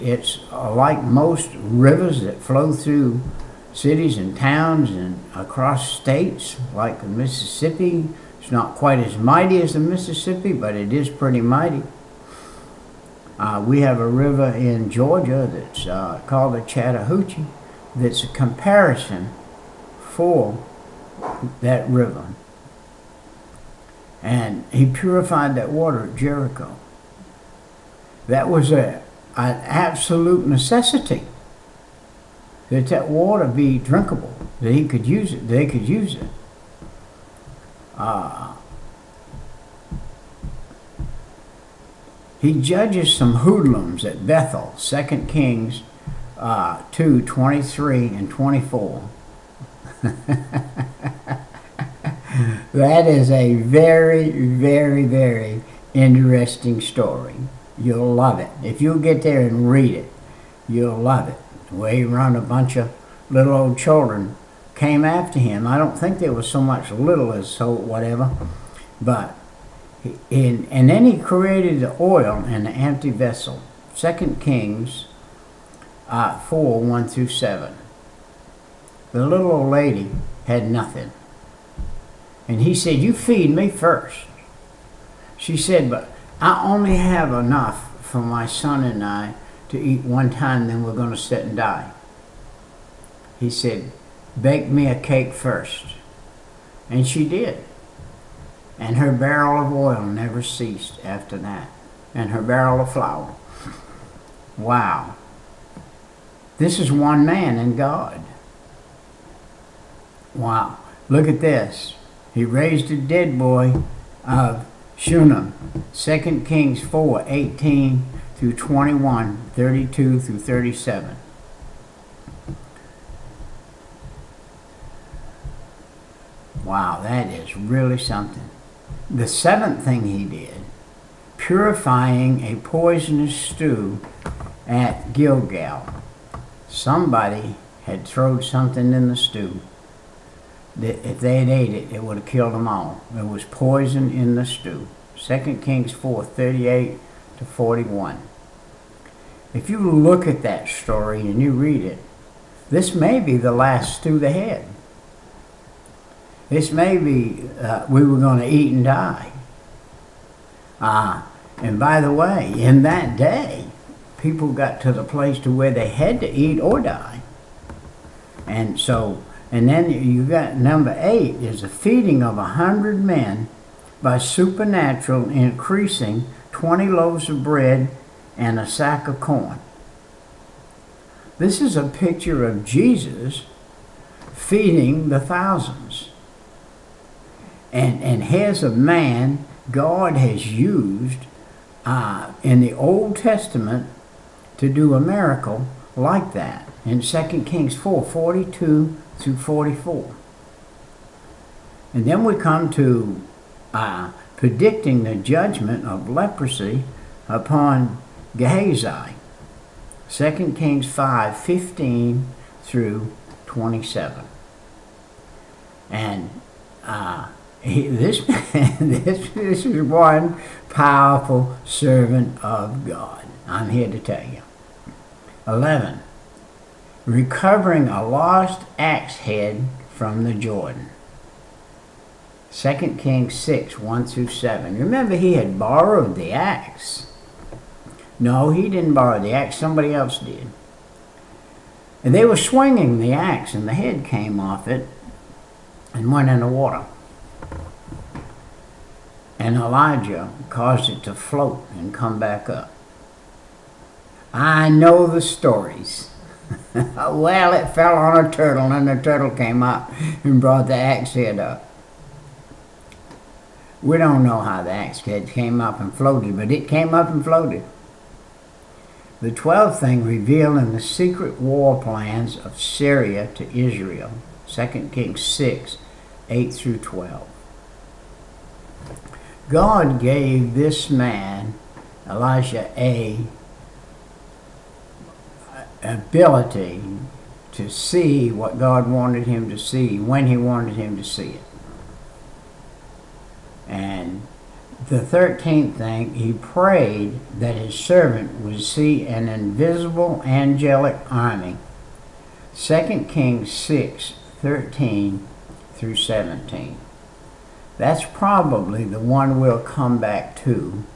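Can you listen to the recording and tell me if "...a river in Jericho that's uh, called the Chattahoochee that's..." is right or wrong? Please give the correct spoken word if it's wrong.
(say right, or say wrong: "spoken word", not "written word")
wrong: "Georgia", not "Jericho".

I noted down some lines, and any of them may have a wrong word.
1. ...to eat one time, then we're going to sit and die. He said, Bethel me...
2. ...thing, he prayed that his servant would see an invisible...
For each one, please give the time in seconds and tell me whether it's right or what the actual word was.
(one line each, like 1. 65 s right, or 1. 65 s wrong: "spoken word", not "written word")
1. 89 s wrong: "Bake", not "Bethel"
2. 295 s right.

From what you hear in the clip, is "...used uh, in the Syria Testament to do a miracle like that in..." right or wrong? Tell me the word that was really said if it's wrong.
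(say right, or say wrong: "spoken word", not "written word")
wrong: "Old", not "Syria".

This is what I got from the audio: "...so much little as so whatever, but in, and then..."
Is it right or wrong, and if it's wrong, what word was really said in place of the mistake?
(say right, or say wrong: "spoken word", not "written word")
right.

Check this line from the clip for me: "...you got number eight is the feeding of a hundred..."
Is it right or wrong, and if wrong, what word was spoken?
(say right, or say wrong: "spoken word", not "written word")
right.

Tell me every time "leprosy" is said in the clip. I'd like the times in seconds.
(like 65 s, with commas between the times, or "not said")
206 s.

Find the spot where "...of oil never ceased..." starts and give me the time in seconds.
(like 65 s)
99 s.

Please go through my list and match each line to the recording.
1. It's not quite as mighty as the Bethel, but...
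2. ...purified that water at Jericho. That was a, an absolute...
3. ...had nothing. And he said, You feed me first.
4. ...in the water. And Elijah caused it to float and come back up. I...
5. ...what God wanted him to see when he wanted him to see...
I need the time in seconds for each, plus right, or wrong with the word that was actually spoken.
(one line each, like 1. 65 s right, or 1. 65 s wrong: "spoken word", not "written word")
1. 8 s wrong: "Mississippi", not "Bethel"
2. 24 s right
3. 80 s right
4. 246 s right
5. 288 s right.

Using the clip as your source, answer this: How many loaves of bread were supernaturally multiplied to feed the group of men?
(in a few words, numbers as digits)
20.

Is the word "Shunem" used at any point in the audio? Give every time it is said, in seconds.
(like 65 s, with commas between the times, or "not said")
114 s.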